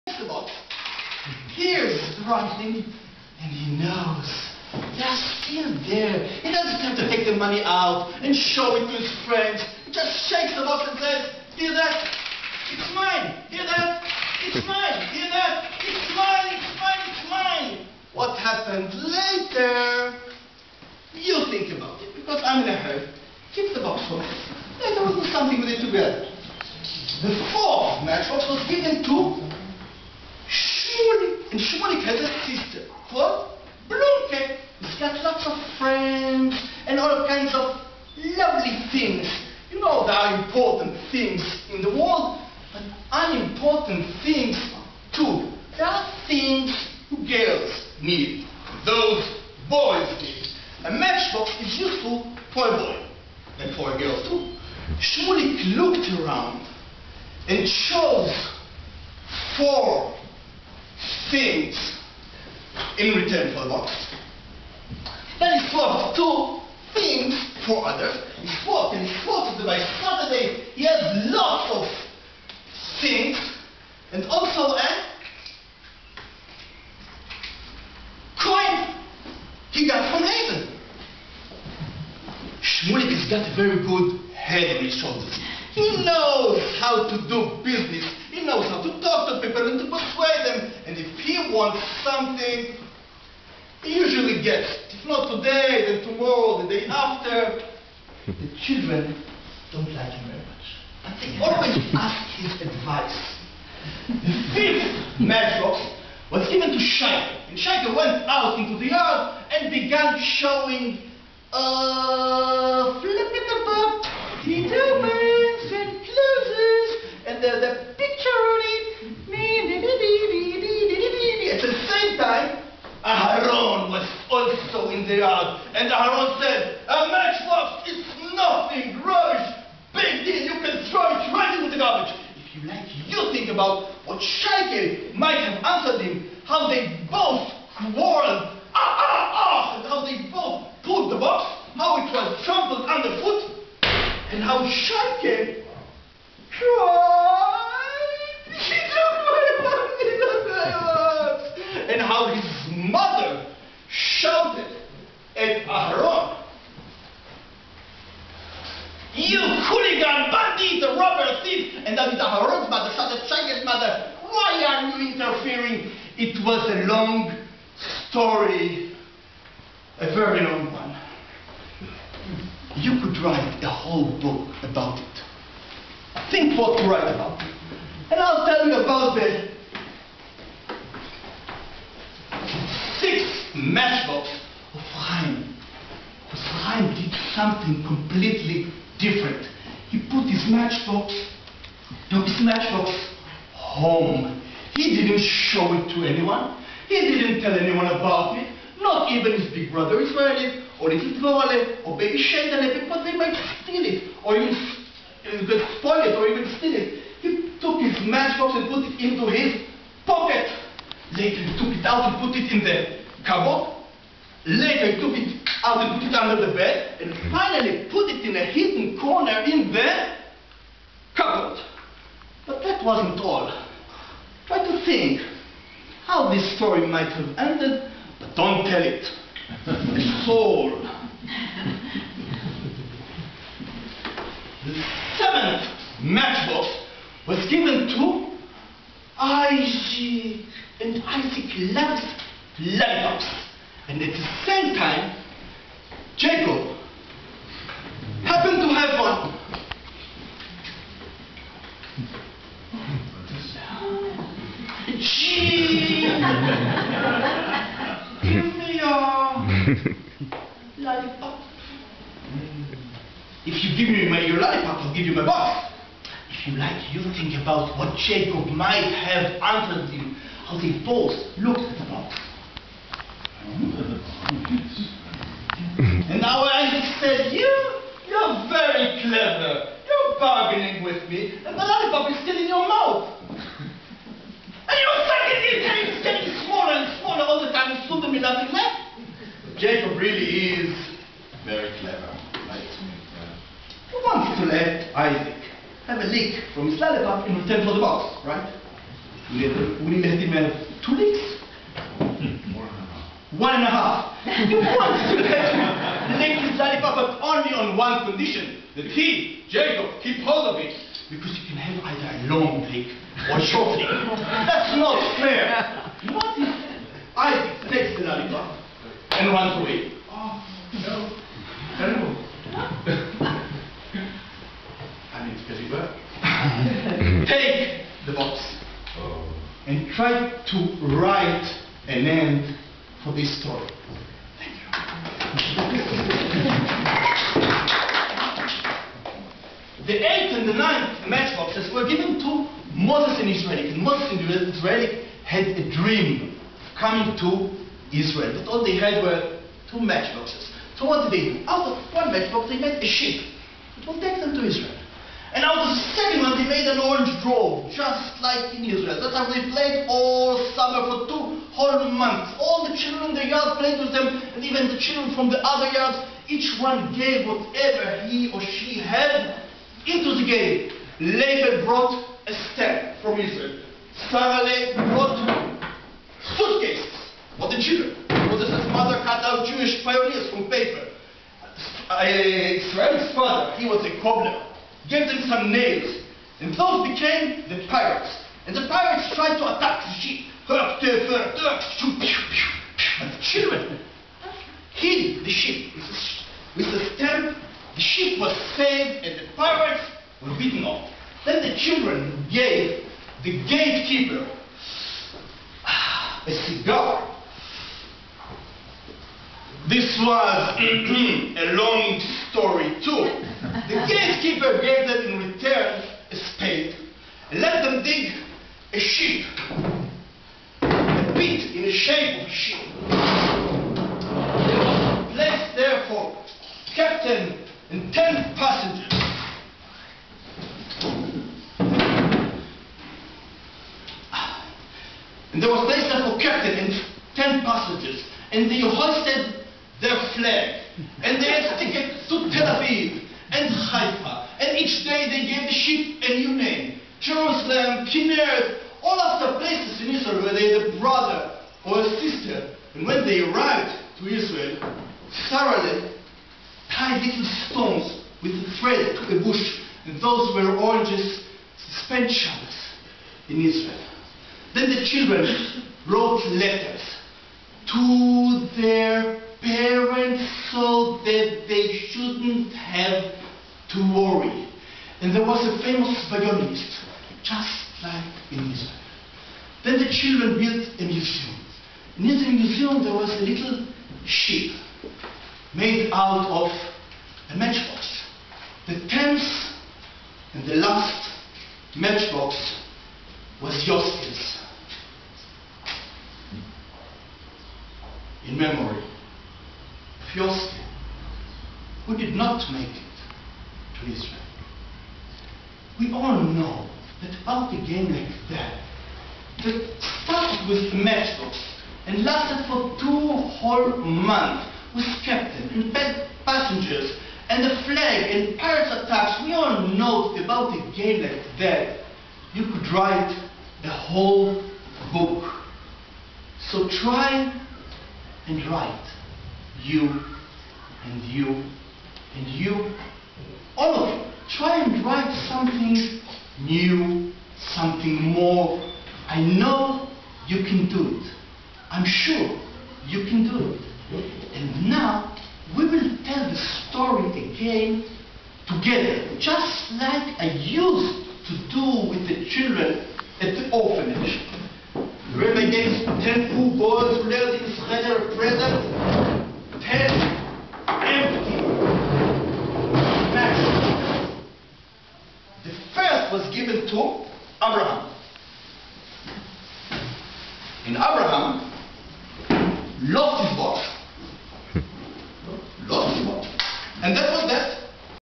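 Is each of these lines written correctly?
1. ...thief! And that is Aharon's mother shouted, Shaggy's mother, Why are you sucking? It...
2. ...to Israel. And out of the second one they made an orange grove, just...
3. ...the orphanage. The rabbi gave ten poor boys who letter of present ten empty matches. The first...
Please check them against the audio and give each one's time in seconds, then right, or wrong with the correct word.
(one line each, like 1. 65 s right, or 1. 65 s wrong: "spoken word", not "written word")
1. 161 s wrong: "interfering", not "sucking"
2. 354 s right
3. 553 s right.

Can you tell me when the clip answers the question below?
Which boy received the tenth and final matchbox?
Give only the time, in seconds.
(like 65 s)
493 s.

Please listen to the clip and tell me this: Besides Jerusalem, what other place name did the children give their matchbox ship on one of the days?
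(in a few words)
Kinneret.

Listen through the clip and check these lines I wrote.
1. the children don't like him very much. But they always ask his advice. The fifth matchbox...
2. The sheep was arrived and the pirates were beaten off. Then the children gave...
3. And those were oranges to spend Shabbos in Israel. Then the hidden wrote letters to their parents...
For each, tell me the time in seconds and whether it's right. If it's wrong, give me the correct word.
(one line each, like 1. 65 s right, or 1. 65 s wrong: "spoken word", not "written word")
1. 98 s right
2. 397 s wrong: "saved", not "arrived"
3. 459 s wrong: "children", not "hidden".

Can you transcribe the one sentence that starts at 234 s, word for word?
The seventh matchbox was given to Isaac, and Isaac left lollipops.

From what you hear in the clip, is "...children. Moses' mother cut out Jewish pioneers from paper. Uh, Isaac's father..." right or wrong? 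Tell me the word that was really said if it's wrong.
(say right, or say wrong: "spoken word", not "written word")
wrong: "Israel", not "Isaac".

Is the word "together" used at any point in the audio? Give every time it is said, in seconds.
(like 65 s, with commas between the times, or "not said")
25 s, 548 s.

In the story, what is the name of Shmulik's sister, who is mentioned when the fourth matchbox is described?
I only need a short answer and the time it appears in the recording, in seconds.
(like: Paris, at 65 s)
Blomke, at 33 s.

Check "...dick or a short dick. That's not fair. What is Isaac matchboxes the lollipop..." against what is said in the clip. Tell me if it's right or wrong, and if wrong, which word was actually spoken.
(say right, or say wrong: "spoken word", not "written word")
wrong: "takes", not "matchboxes".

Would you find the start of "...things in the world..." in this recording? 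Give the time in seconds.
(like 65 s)
41 s.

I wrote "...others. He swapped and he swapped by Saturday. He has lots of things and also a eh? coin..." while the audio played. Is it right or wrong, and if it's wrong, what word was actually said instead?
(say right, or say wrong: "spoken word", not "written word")
right.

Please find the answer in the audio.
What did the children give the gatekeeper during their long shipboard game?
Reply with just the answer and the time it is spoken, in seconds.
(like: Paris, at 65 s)
a cigar, at 406 s.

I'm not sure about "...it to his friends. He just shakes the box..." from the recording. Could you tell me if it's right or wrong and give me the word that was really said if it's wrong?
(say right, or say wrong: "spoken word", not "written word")
right.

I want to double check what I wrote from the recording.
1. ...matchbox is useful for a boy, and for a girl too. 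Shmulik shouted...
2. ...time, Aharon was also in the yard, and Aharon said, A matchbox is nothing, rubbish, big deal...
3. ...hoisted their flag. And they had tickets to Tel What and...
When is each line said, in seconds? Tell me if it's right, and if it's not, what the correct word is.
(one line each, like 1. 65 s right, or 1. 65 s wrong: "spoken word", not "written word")
1. 50 s wrong: "looked", not "shouted"
2. 122 s right
3. 438 s wrong: "Aviv", not "What".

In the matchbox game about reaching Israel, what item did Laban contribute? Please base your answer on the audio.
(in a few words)
a stamp from Israel.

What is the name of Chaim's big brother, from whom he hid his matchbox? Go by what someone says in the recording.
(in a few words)
Israeli.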